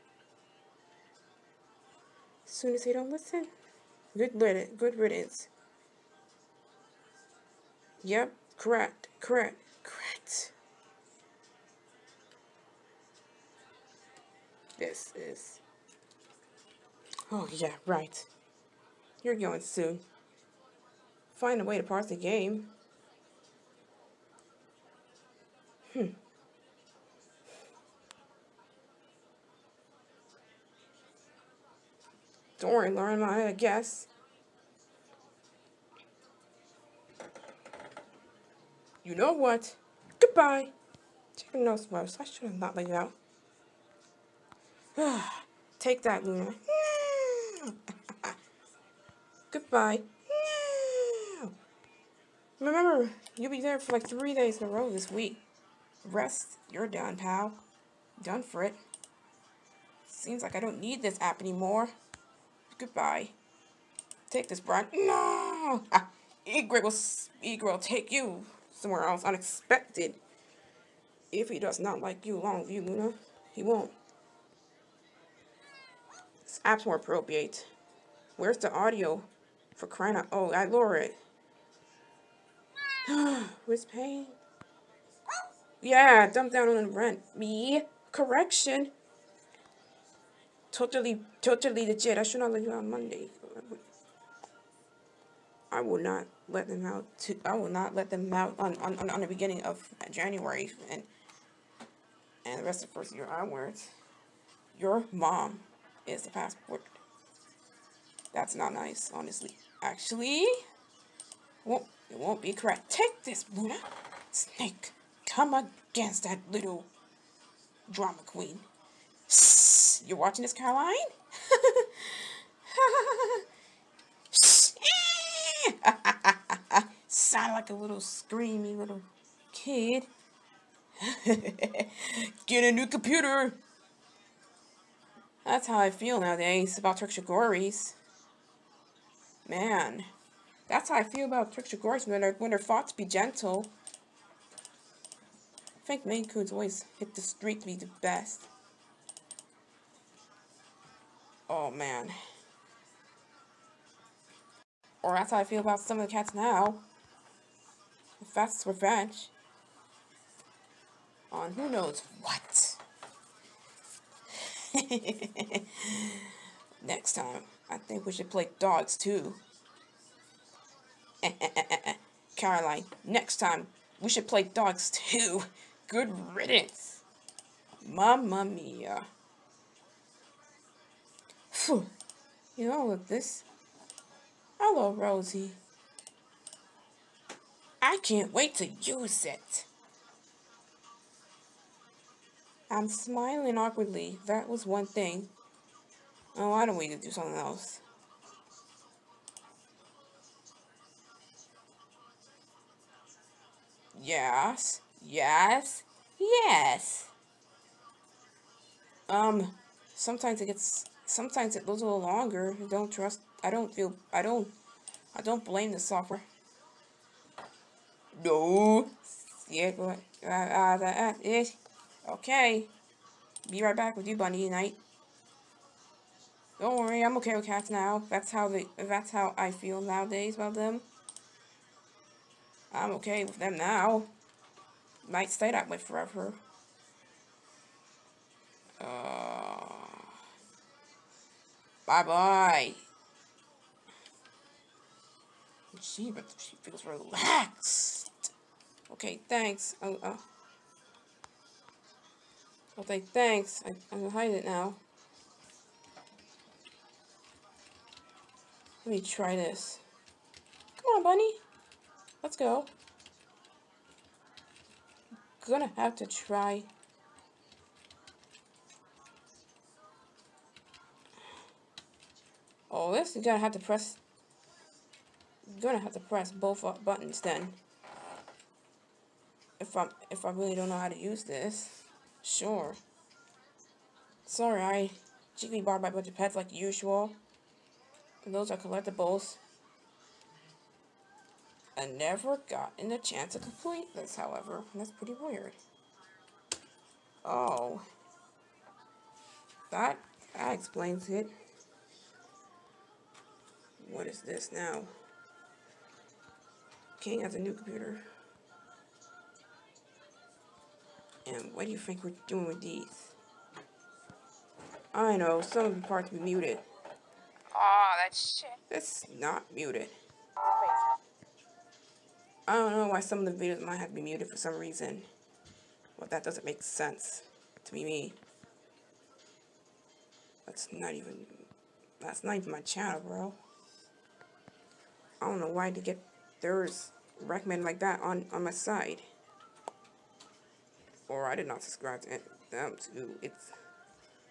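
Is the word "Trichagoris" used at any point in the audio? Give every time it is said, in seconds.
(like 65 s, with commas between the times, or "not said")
136 s, 141 s.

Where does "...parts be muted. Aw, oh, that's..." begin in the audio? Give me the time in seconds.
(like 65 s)
315 s.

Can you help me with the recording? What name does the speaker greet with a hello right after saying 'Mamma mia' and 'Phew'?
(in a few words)
Rosie.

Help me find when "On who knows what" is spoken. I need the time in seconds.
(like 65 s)
161 s.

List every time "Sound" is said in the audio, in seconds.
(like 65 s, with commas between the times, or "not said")
127 s.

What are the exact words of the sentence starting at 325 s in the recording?
Well, that doesn't make sense to me.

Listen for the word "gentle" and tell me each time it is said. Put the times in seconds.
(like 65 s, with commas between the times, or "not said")
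143 s.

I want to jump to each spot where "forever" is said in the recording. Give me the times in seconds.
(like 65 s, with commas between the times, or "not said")
235 s.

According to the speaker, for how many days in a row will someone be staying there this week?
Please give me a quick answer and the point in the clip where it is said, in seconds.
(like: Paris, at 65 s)
3, at 54 s.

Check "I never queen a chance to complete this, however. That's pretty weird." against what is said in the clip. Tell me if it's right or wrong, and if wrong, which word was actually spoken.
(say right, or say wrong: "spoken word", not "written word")
wrong: "gotten", not "queen".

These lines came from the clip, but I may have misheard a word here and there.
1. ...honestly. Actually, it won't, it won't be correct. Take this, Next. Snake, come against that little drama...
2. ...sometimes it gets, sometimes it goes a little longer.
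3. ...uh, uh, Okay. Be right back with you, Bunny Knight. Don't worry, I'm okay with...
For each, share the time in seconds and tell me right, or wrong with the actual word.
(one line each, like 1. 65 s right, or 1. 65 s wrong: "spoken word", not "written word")
1. 109 s wrong: "Luna", not "Next"
2. 209 s right
3. 220 s right.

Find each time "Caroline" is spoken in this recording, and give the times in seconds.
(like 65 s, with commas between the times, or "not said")
120 s, 172 s.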